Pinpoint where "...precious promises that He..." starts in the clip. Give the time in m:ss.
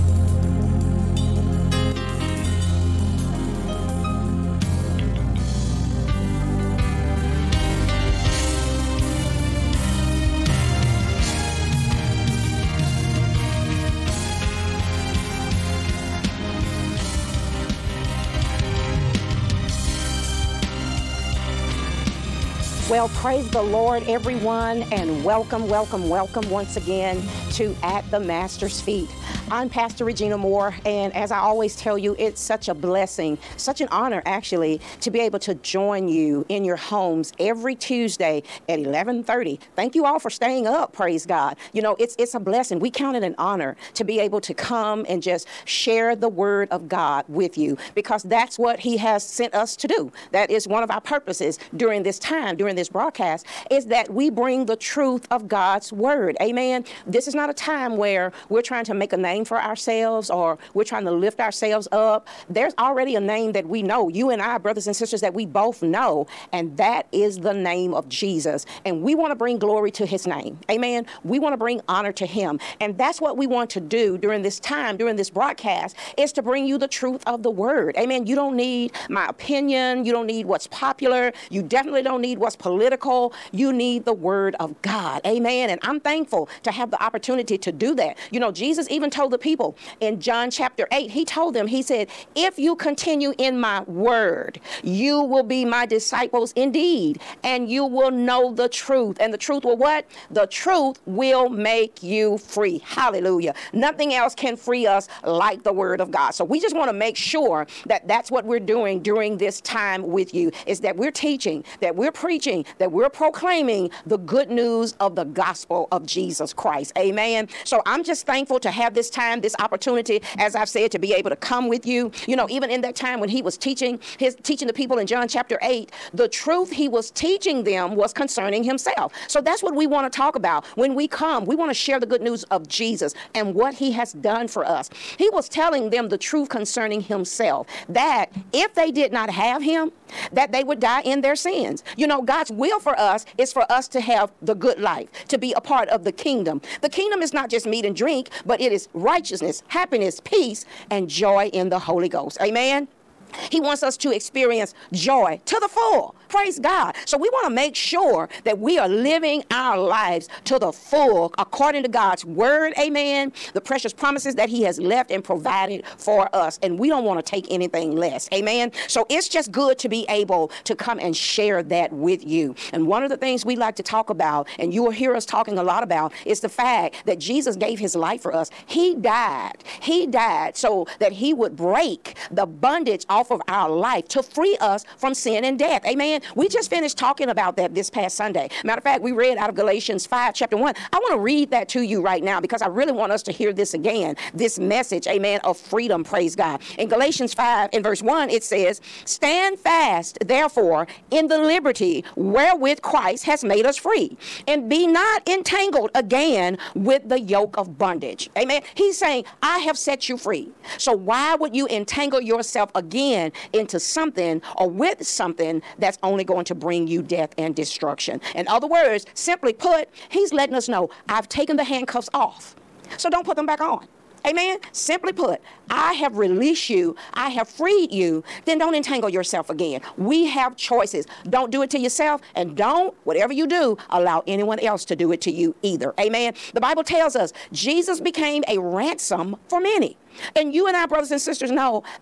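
2:43.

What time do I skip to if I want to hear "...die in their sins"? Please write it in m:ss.
2:20.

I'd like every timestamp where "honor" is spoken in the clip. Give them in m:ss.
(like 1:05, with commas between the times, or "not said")
0:33, 0:43, 1:11.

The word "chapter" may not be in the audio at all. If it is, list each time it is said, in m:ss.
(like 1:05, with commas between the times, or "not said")
1:30, 2:05, 3:10.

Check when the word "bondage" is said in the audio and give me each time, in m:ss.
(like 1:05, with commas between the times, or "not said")
3:02, 3:27.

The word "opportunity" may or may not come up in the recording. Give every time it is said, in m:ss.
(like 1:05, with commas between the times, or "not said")
1:27, 1:59.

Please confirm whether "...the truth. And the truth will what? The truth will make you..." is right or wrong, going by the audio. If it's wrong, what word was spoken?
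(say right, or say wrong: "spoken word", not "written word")
right.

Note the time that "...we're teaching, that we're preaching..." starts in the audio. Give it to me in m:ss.
1:50.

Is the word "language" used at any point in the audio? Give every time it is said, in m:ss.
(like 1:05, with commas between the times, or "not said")
not said.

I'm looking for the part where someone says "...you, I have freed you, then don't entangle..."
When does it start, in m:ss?
3:46.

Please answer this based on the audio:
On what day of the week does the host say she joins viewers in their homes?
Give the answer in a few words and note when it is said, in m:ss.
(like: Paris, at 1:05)
Tuesday, at 0:37.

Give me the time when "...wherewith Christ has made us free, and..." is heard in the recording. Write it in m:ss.
3:22.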